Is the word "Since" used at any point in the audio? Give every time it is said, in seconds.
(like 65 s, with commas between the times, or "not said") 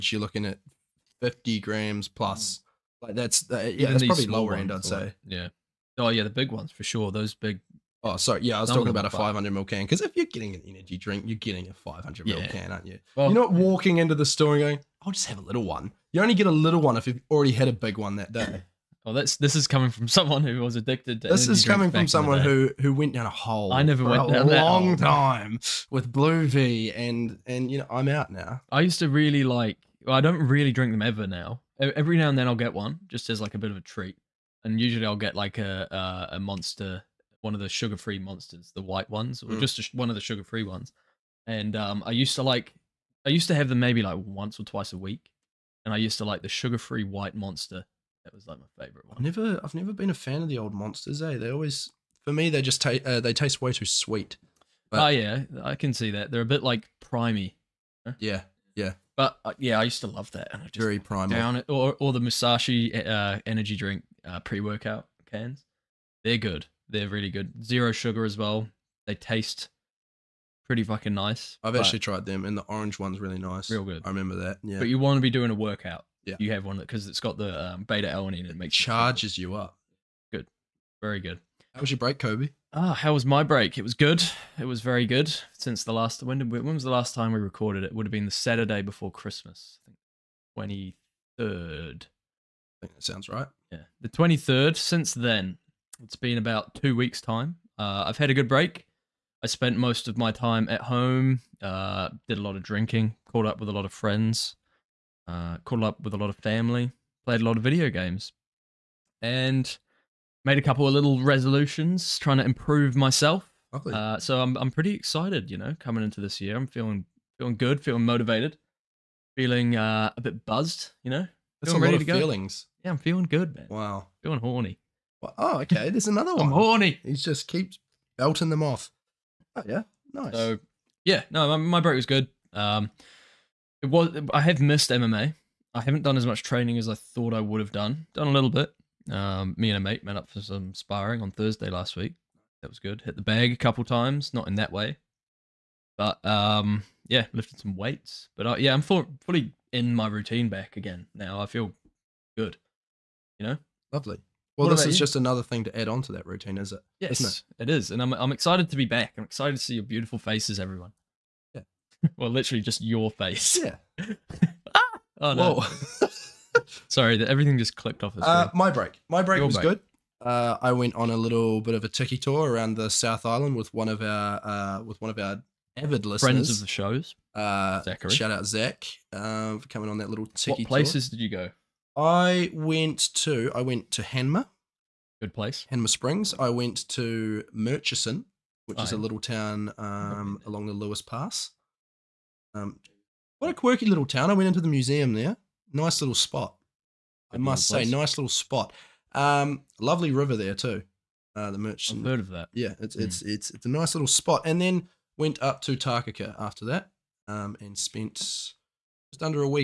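85 s, 94 s.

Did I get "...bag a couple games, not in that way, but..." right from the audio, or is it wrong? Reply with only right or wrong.
wrong.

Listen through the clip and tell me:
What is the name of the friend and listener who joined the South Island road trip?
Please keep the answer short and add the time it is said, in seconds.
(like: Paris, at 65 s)
Zachary, at 177 s.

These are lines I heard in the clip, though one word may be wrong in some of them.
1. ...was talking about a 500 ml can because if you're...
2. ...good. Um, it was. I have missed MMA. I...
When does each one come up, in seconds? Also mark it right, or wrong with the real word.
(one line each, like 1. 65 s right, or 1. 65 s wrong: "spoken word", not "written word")
1. 8 s right
2. 132 s right.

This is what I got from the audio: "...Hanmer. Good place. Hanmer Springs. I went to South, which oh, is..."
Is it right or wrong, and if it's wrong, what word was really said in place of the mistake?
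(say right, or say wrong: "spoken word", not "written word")
wrong: "Murchison", not "South".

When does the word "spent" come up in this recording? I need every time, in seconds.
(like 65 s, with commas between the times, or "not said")
99 s, 207 s.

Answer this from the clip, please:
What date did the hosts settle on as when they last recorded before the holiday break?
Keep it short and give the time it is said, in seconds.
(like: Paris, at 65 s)
23rd, at 94 s.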